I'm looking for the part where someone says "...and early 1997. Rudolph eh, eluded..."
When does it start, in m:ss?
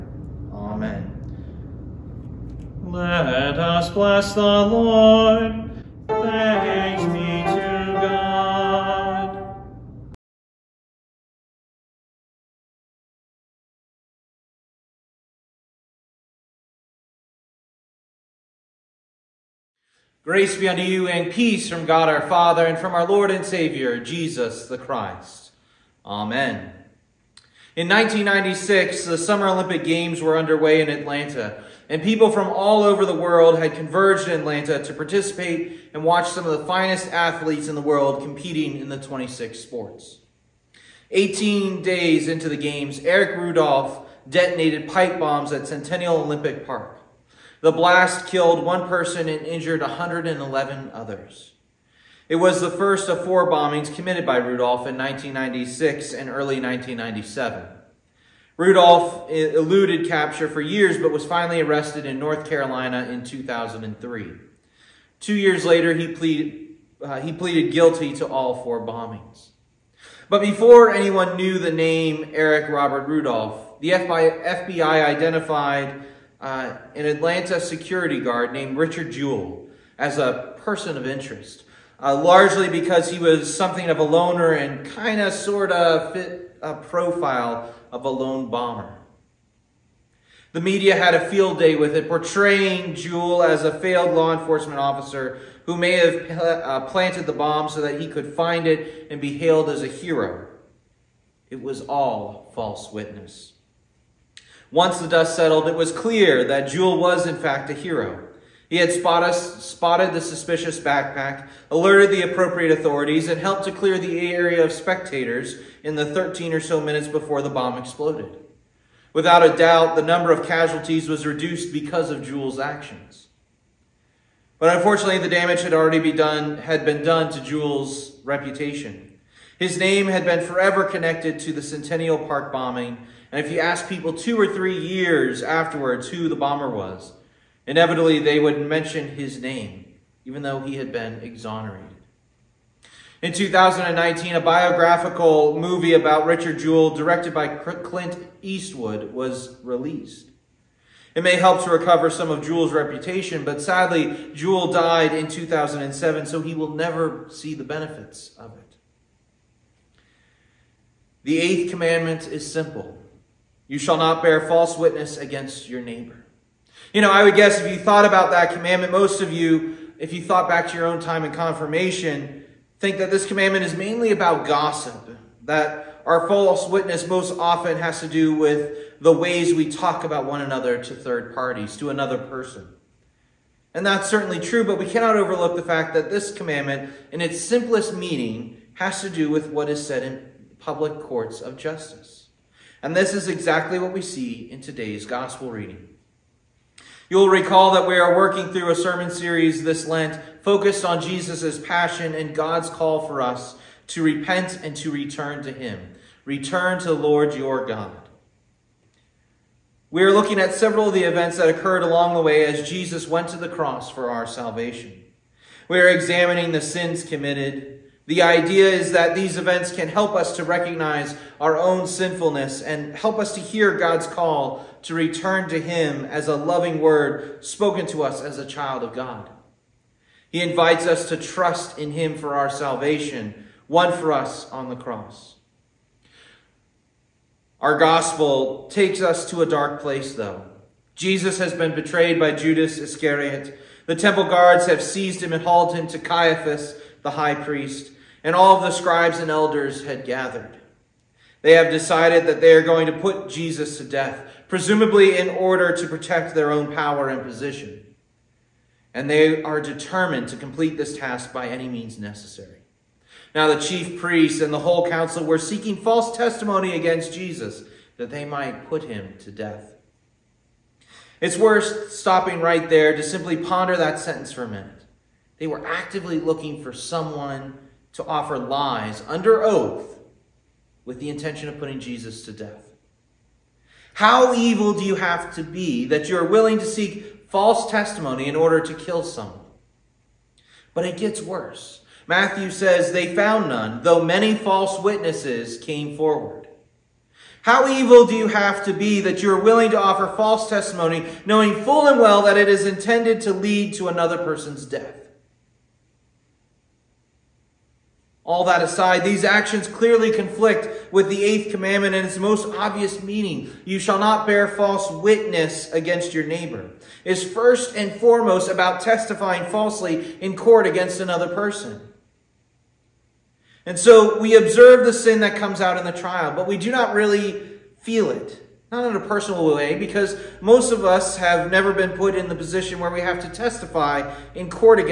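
0:56.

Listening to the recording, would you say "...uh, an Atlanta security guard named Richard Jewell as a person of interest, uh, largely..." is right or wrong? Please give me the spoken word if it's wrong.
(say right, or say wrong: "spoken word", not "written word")
right.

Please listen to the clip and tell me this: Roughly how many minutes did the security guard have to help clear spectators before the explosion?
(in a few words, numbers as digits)
13.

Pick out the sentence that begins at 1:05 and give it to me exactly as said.
Two years later, he pleaded, uh, he pleaded guilty to all four bombings.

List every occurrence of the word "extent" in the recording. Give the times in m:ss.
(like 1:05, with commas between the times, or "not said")
not said.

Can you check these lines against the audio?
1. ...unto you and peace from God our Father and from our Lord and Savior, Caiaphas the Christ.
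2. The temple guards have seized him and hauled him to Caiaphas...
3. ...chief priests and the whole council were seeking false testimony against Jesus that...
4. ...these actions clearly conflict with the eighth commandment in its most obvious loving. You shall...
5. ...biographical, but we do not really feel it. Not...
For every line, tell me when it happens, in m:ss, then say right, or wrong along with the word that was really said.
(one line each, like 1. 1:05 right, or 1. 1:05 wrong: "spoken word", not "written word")
1. 0:20 wrong: "Jesus", not "Caiaphas"
2. 4:03 right
3. 4:23 right
4. 5:09 wrong: "meaning", not "loving"
5. 5:25 wrong: "trial", not "biographical".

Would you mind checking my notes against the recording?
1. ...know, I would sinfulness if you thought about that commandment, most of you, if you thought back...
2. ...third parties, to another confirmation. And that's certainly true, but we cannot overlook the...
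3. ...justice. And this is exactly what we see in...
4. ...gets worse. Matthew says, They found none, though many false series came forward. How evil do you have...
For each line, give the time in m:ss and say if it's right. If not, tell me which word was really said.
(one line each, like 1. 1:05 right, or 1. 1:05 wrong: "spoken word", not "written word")
1. 2:47 wrong: "guess", not "sinfulness"
2. 3:00 wrong: "person", not "confirmation"
3. 3:11 right
4. 4:50 wrong: "witnesses", not "series".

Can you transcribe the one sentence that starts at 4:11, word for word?
They have decided that they are going to put Jesus to death, presumably in order to protect their own power and position.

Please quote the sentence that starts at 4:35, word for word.
They were actively looking for someone to offer lies under oath with the intention of putting Jesus to death?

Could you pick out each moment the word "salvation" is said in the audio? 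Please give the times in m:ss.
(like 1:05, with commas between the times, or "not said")
3:34, 3:52.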